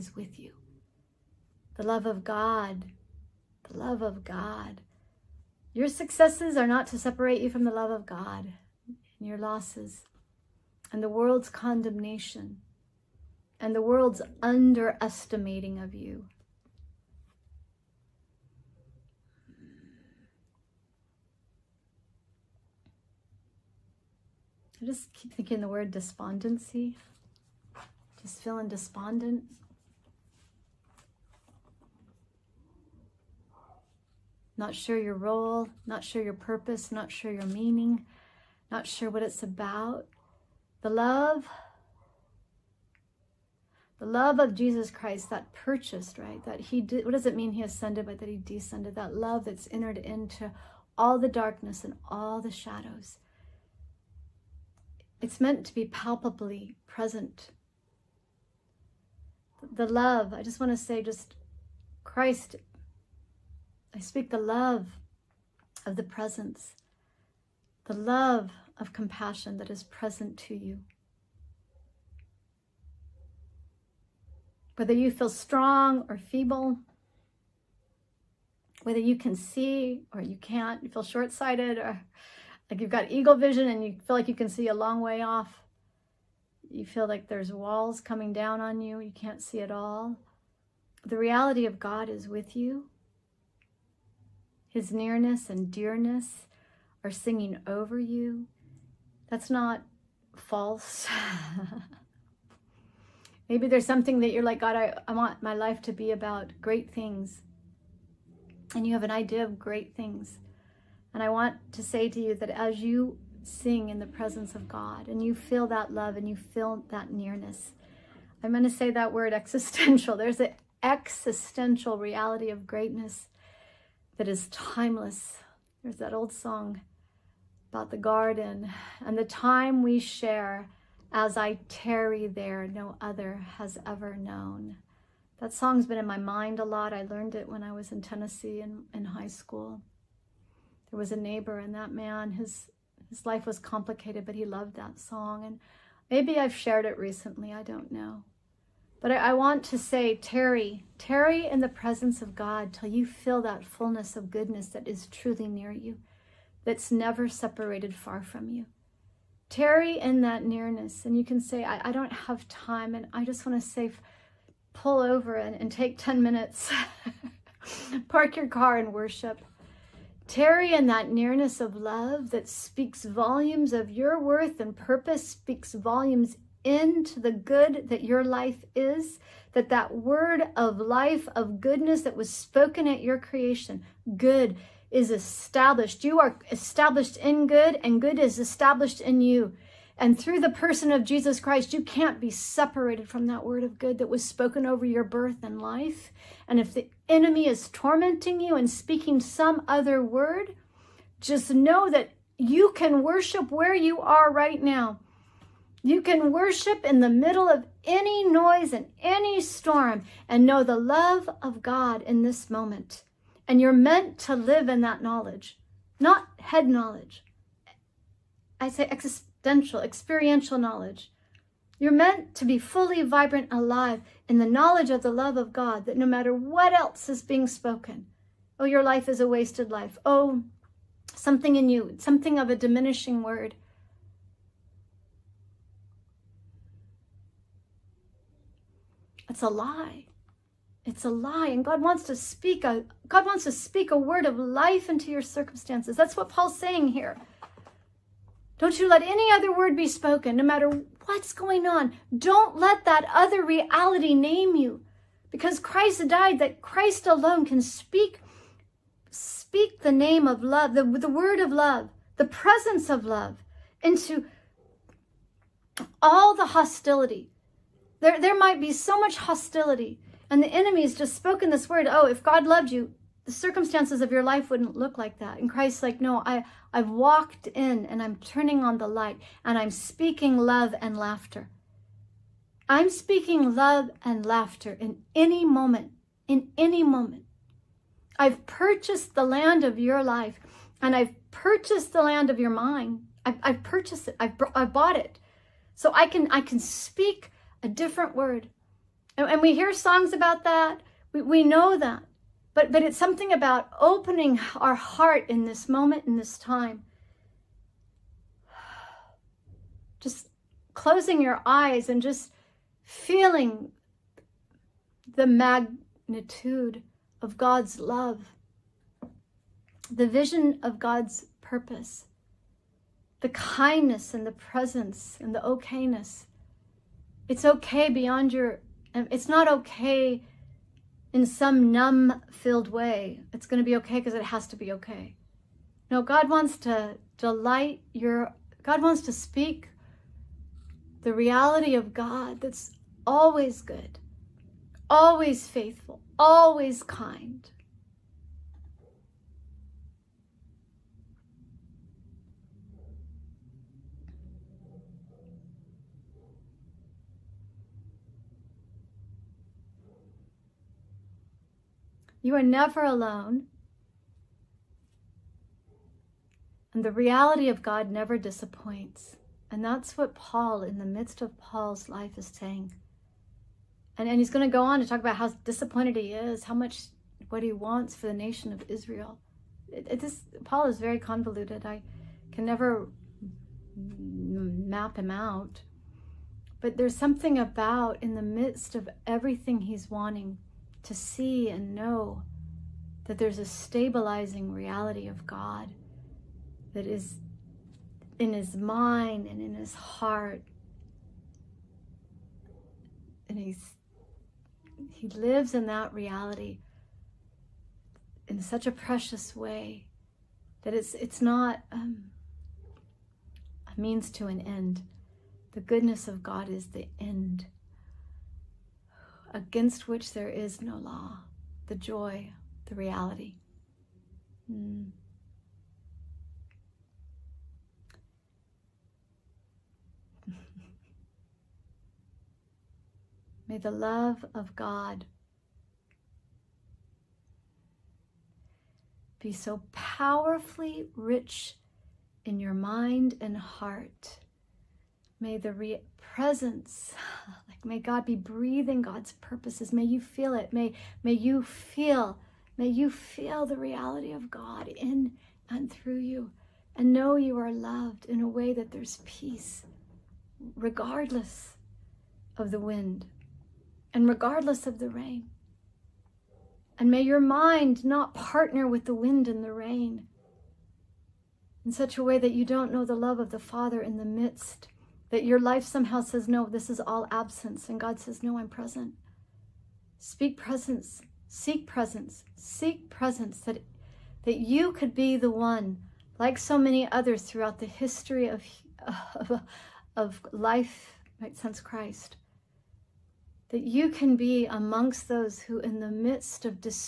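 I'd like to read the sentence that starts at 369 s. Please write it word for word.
And that's what Paul, in the midst of Paul's life, is saying.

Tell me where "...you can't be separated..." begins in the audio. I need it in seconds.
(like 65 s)
191 s.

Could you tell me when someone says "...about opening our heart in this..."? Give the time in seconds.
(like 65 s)
303 s.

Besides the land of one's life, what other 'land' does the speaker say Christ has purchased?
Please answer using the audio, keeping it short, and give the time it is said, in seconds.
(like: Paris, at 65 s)
the land of your mind, at 292 s.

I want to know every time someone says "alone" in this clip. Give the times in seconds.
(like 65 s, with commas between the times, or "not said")
257 s, 362 s.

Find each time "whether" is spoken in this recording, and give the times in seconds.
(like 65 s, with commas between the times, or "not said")
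74 s, 78 s.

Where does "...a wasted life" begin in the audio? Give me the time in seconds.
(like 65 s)
229 s.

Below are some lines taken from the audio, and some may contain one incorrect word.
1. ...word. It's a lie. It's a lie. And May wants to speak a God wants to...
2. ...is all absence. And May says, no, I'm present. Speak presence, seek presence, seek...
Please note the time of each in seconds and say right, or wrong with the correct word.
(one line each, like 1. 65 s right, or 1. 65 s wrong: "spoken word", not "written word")
1. 233 s wrong: "God", not "May"
2. 476 s wrong: "God", not "May".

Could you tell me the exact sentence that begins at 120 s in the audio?
There's an existential reality of greatness that is timeless.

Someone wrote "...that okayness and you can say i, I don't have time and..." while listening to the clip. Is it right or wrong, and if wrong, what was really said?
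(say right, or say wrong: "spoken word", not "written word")
wrong: "nearness", not "okayness".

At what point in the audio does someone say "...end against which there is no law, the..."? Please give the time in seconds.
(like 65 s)
416 s.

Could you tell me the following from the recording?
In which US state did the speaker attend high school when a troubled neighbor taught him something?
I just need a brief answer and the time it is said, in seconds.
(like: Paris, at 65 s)
Tennessee, at 137 s.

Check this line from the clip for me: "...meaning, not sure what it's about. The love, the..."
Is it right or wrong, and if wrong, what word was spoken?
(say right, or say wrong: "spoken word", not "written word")
right.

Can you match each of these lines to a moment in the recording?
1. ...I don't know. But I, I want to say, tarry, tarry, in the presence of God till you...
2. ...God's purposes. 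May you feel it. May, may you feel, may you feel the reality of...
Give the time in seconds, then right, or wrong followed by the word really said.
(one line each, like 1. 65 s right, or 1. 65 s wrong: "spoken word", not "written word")
1. 147 s right
2. 448 s right.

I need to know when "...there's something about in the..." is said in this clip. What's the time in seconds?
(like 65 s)
386 s.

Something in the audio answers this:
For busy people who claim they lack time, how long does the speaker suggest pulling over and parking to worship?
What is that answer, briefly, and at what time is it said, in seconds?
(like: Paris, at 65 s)
10 minutes, at 165 s.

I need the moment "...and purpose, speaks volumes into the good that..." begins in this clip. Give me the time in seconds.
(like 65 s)
174 s.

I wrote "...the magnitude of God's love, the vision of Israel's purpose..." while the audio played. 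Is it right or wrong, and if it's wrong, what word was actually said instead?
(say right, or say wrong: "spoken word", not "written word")
wrong: "God", not "Israel".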